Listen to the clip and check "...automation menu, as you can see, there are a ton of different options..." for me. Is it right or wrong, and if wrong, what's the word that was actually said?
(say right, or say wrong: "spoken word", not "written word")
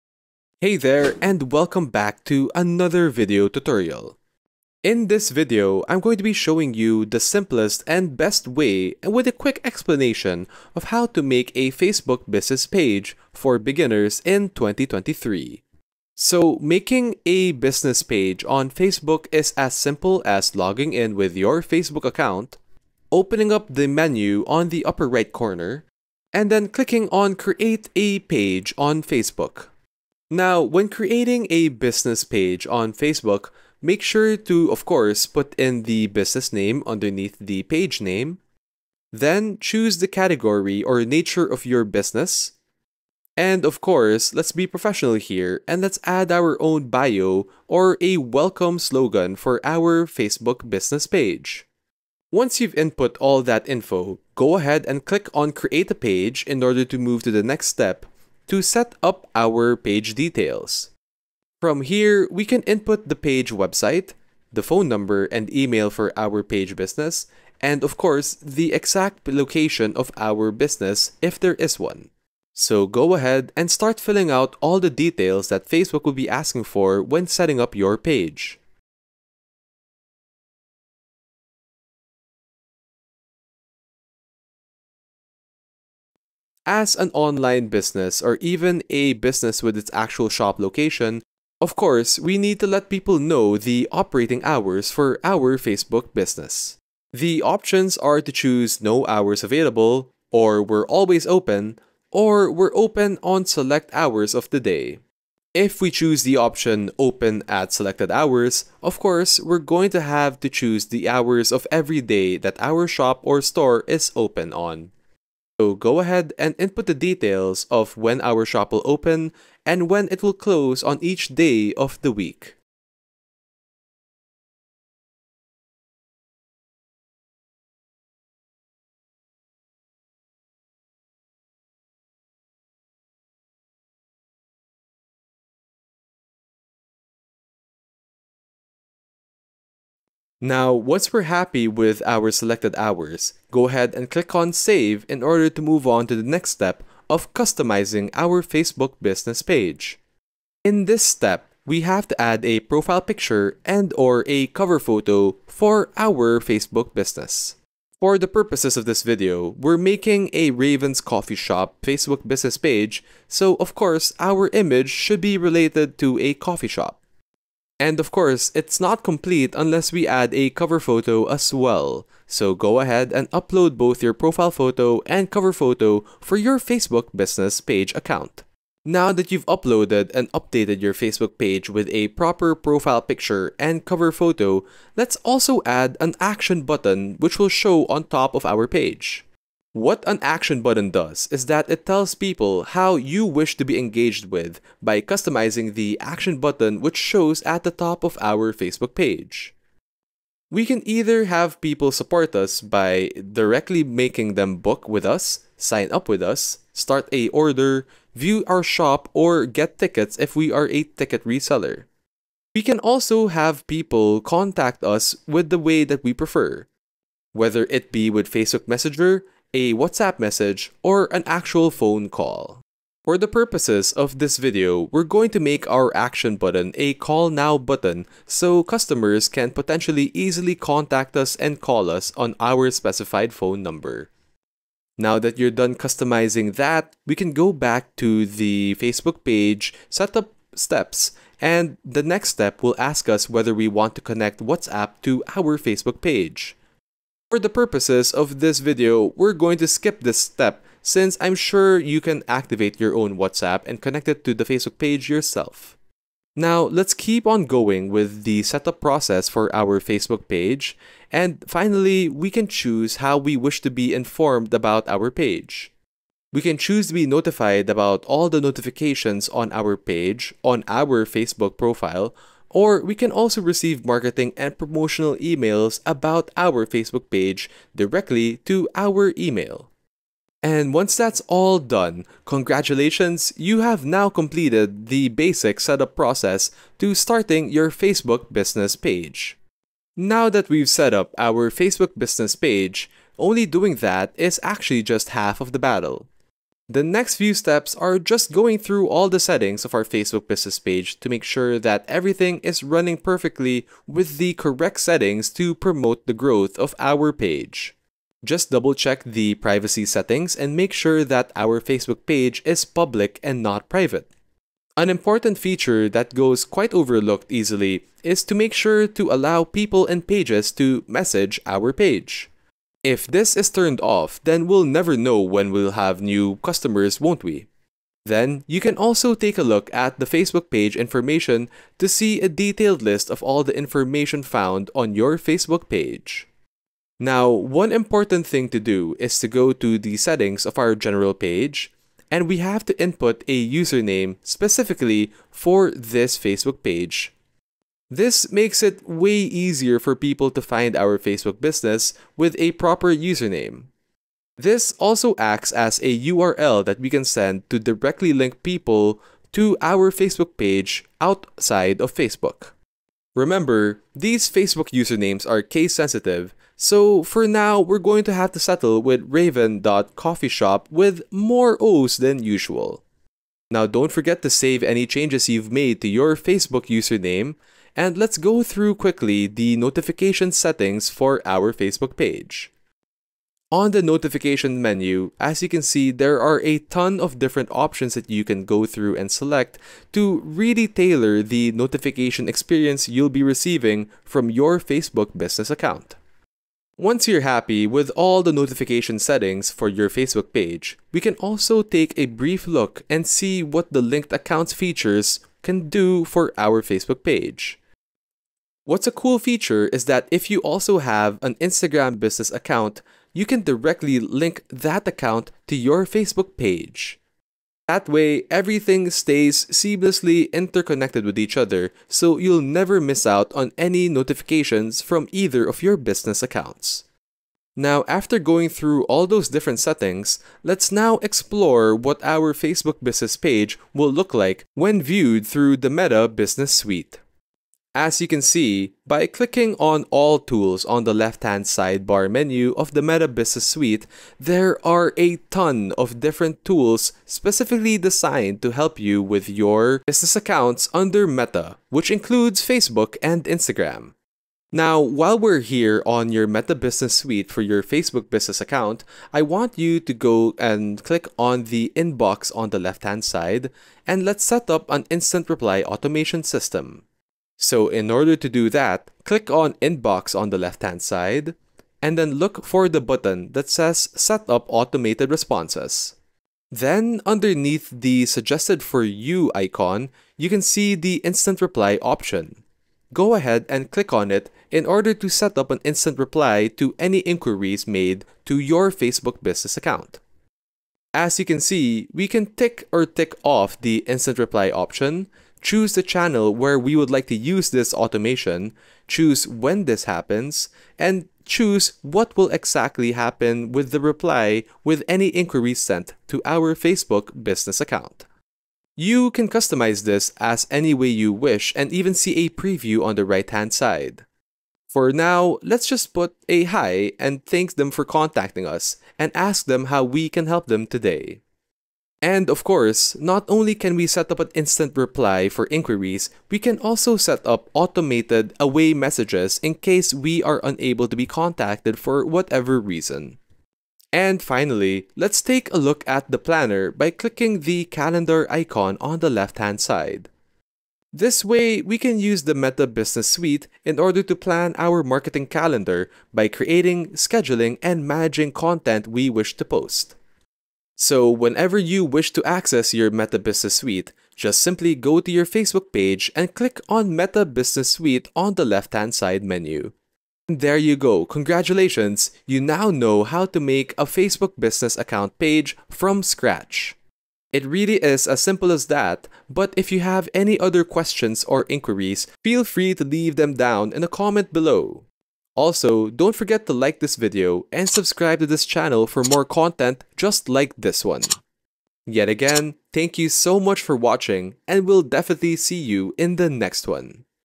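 wrong: "notification", not "automation".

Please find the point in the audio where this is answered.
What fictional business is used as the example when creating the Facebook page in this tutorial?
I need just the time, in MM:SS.
02:40.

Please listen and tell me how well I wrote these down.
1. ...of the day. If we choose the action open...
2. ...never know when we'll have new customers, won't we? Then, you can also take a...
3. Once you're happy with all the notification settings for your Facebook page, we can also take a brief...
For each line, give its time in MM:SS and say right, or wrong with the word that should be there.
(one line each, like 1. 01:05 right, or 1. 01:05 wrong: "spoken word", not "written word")
1. 01:44 wrong: "option", not "action"
2. 05:24 right
3. 06:36 right.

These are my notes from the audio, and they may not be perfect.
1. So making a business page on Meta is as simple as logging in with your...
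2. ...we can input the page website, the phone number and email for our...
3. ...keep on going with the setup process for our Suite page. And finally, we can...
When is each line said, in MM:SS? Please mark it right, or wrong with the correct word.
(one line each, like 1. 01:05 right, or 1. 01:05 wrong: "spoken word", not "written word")
1. 00:16 wrong: "Facebook", not "Meta"
2. 01:02 right
3. 04:16 wrong: "Facebook", not "Suite".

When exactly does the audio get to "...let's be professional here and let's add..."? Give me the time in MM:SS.
00:44.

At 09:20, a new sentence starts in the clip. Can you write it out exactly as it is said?
there you go, congratulations, you now know how to make a Facebook business account page from scratch.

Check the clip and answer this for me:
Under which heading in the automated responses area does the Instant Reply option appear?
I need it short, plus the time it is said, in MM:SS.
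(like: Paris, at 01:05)
Suggested for You, at 07:58.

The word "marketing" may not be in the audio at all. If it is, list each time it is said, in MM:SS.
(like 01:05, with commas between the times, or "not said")
04:33, 09:04.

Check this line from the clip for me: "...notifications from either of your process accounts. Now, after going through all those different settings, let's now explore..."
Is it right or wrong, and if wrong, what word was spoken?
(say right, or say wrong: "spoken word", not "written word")
wrong: "business", not "process".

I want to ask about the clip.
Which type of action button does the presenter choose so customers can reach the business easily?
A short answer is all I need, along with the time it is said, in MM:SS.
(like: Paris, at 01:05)
call now, at 03:46.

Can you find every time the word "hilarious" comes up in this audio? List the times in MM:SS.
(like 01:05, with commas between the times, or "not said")
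not said.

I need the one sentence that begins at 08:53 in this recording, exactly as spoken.
And finally, let's take a look at the planner by clicking the calendar icon on the left-hand side.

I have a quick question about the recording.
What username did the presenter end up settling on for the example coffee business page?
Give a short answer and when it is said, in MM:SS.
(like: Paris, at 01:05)
raven.coffeeshop, at 06:09.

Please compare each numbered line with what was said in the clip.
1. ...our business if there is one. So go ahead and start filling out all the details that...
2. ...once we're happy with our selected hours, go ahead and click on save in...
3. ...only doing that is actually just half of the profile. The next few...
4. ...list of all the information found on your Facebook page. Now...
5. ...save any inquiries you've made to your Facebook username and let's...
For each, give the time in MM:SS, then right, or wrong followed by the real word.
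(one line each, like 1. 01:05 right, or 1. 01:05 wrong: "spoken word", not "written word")
1. 01:10 right
2. 02:20 right
3. 04:53 wrong: "battle", not "profile"
4. 05:32 right
5. 06:14 wrong: "changes", not "inquiries".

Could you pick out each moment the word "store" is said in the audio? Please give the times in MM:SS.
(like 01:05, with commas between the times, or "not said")
01:53.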